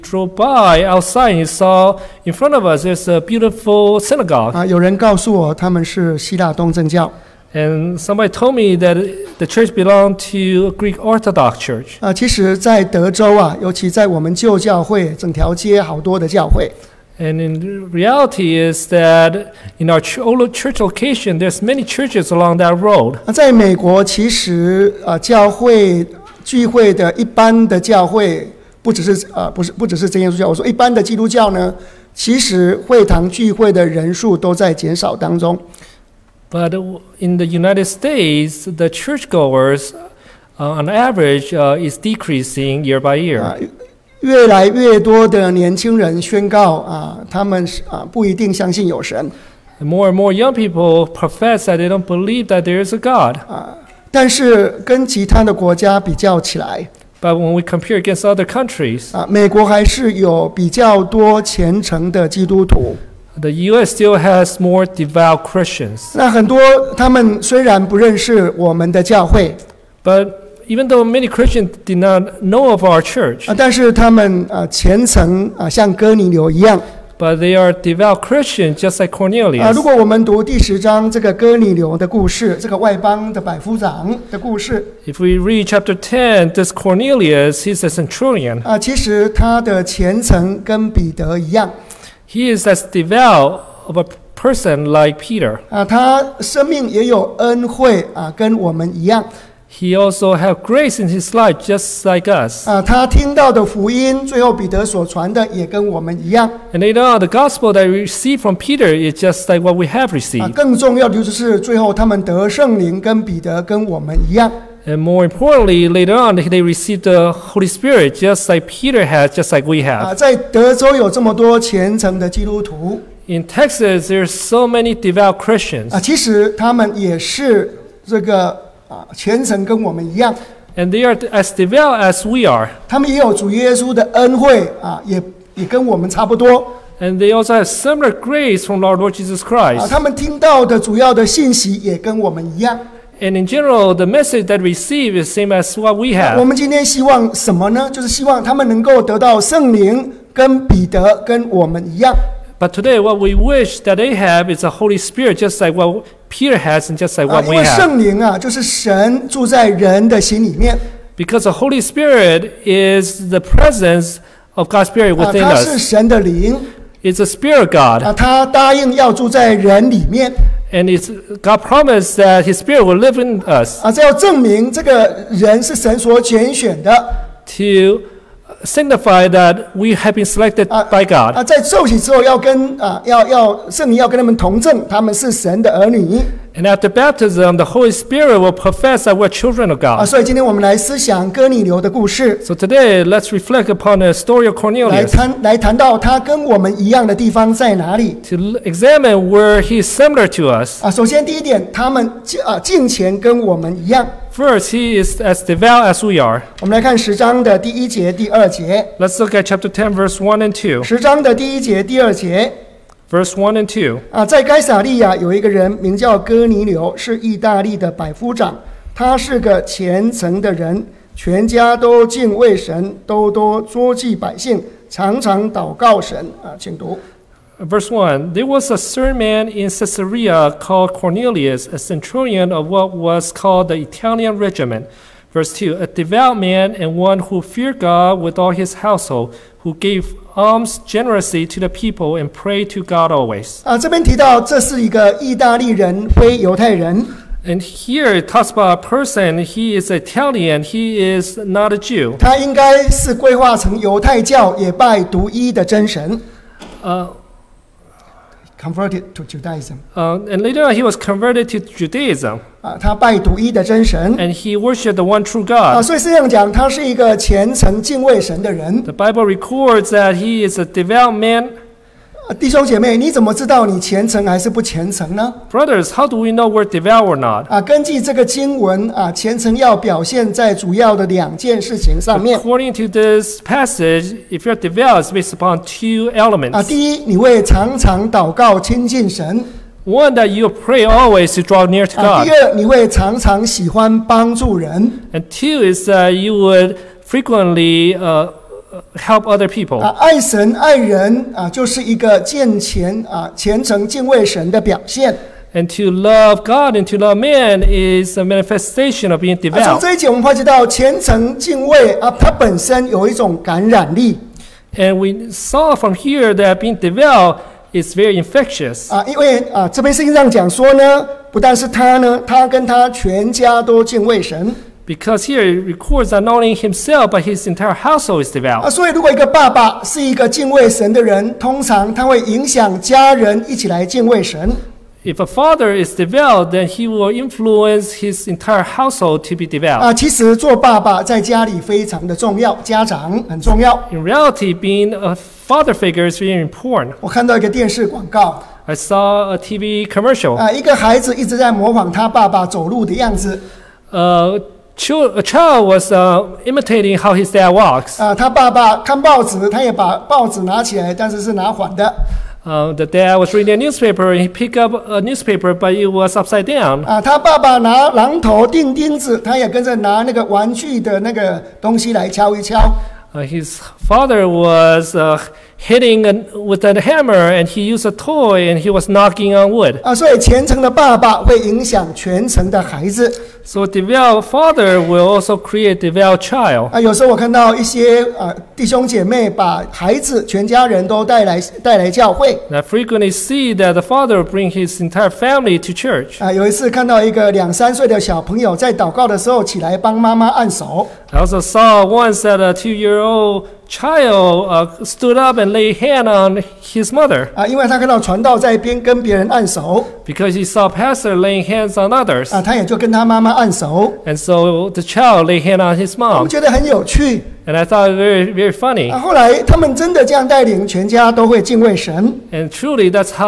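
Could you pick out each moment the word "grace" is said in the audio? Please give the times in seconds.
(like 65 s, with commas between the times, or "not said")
100 s, 138 s.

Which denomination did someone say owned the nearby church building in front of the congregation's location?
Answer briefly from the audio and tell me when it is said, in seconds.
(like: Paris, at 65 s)
Greek Orthodox, at 10 s.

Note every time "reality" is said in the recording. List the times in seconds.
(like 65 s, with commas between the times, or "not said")
17 s, 344 s.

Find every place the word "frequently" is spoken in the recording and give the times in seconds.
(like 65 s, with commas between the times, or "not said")
297 s, 386 s.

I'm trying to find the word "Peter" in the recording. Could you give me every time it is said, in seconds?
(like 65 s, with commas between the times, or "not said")
95 s, 108 s, 118 s, 156 s.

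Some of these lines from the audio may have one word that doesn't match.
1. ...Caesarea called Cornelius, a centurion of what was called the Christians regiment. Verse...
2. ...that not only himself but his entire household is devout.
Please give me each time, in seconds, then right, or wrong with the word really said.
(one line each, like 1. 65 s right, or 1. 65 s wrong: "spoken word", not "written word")
1. 229 s wrong: "Italian", not "Christians"
2. 326 s right.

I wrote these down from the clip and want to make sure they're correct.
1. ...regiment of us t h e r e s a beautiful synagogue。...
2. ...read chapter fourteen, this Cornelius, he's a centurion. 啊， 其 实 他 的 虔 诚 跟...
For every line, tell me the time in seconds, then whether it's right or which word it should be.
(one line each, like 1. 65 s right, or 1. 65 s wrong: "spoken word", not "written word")
1. 2 s wrong: "front", not "regiment"
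2. 85 s wrong: "ten", not "fourteen".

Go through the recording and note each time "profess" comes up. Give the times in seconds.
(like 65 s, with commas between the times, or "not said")
51 s, 188 s.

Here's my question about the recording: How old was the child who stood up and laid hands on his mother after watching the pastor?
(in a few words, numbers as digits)
2.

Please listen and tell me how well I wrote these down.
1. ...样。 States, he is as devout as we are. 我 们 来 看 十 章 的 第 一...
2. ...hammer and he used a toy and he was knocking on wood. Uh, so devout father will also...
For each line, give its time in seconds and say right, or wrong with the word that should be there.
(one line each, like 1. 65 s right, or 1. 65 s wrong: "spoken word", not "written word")
1. 203 s wrong: "First", not "States"
2. 376 s right.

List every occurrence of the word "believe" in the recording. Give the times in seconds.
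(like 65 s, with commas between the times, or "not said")
52 s.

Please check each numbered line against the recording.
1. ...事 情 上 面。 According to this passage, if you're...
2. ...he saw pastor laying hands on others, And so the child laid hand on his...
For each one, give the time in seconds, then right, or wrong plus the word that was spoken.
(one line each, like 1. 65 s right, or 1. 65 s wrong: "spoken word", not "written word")
1. 281 s right
2. 410 s right.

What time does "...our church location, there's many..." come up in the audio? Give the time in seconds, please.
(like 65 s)
19 s.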